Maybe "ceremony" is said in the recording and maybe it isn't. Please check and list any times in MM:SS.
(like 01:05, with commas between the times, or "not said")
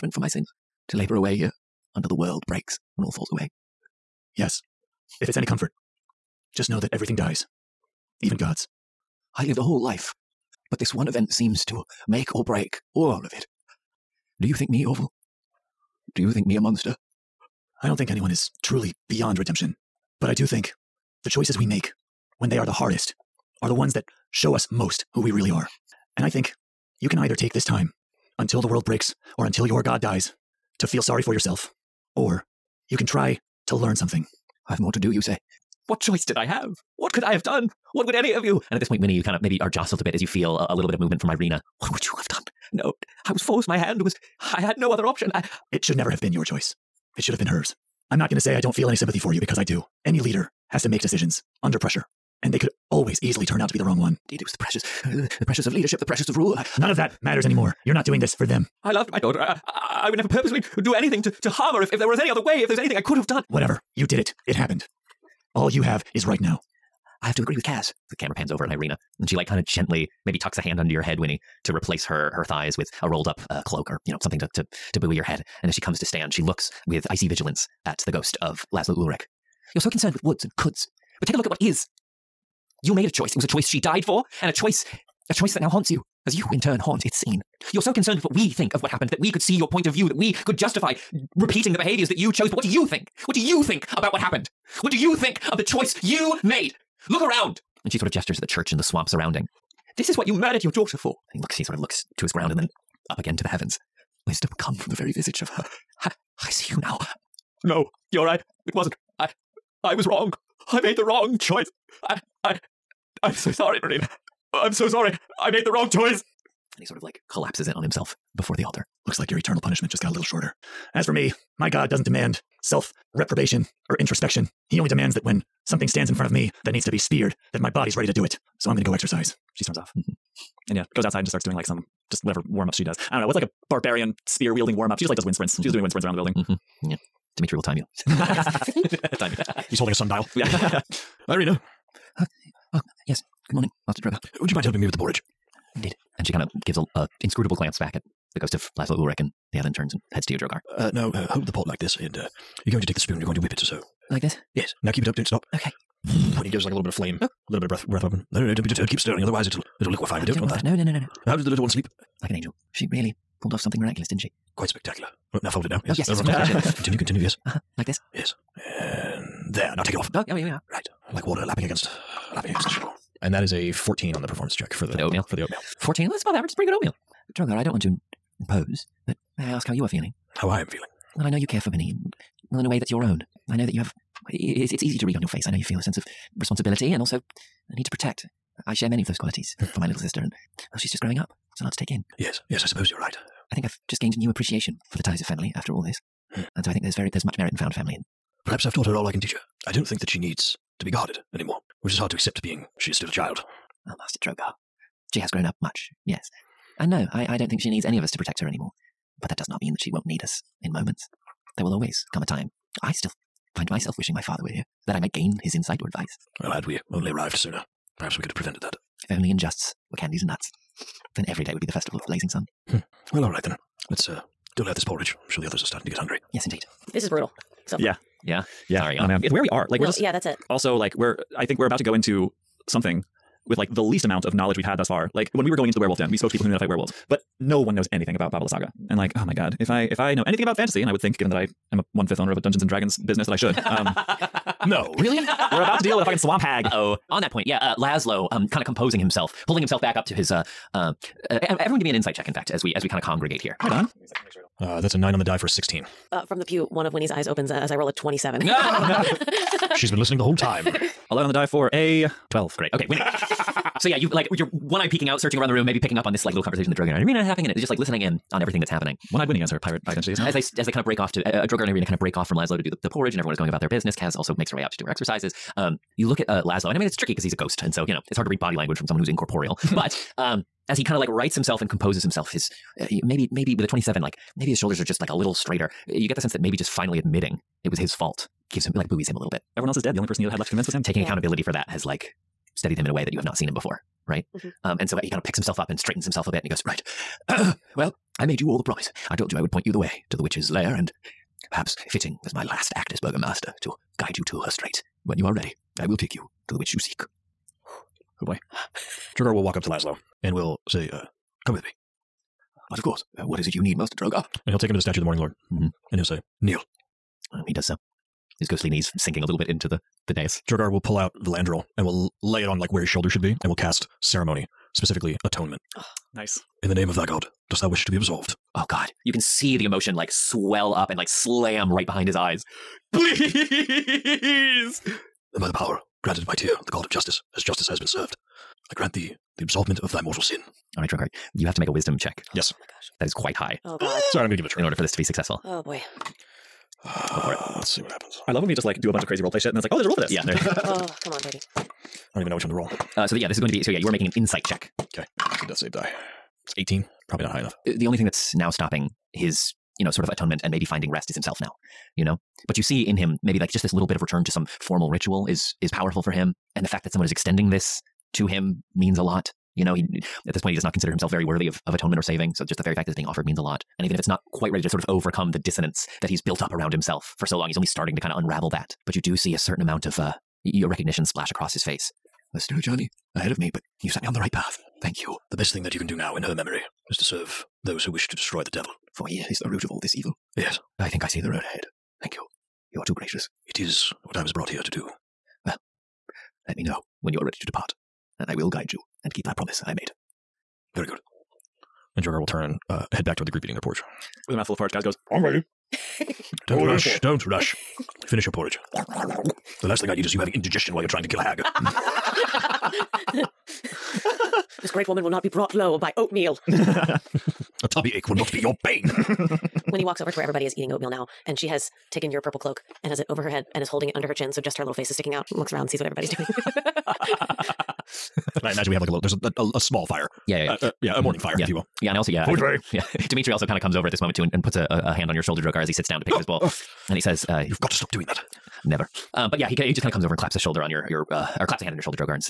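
05:24.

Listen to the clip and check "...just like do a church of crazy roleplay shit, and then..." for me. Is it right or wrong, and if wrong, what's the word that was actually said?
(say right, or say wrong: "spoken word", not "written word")
wrong: "bunch", not "church".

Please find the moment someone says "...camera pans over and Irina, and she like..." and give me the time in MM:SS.
01:08.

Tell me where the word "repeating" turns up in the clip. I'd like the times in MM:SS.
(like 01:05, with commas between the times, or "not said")
01:31.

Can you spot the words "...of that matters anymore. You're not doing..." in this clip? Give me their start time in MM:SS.
00:56.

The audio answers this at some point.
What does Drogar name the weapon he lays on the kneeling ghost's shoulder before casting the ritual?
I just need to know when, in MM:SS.
05:21.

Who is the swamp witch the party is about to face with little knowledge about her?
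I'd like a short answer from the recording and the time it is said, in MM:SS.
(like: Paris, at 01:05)
Baba Lysaga, at 03:58.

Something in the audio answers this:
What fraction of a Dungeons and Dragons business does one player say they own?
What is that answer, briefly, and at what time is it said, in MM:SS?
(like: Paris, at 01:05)
one fifth, at 04:01.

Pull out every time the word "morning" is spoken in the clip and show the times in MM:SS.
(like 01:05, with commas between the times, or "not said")
02:23, 05:15, 07:11.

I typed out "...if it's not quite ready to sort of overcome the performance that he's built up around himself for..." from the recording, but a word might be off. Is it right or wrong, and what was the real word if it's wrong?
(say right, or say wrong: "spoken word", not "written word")
wrong: "dissonance", not "performance".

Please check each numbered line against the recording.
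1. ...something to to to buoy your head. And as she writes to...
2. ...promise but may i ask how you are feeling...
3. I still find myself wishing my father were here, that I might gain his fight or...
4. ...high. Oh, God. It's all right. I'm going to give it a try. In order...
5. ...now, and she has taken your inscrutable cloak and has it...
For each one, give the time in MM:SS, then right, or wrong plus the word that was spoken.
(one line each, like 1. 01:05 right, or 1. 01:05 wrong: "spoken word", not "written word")
1. 01:14 wrong: "comes", not "writes"
2. 02:58 wrong: "impose", not "promise"
3. 03:32 wrong: "insight", not "fight"
4. 05:43 right
5. 07:00 wrong: "purple", not "inscrutable".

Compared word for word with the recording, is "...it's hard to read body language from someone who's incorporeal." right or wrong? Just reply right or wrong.
right.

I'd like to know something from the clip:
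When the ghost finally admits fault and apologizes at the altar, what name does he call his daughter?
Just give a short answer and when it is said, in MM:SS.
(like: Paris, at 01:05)
Marina, at 01:53.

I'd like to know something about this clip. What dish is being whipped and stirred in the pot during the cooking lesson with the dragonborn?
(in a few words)
borage.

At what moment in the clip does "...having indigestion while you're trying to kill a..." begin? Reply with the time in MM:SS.
06:50.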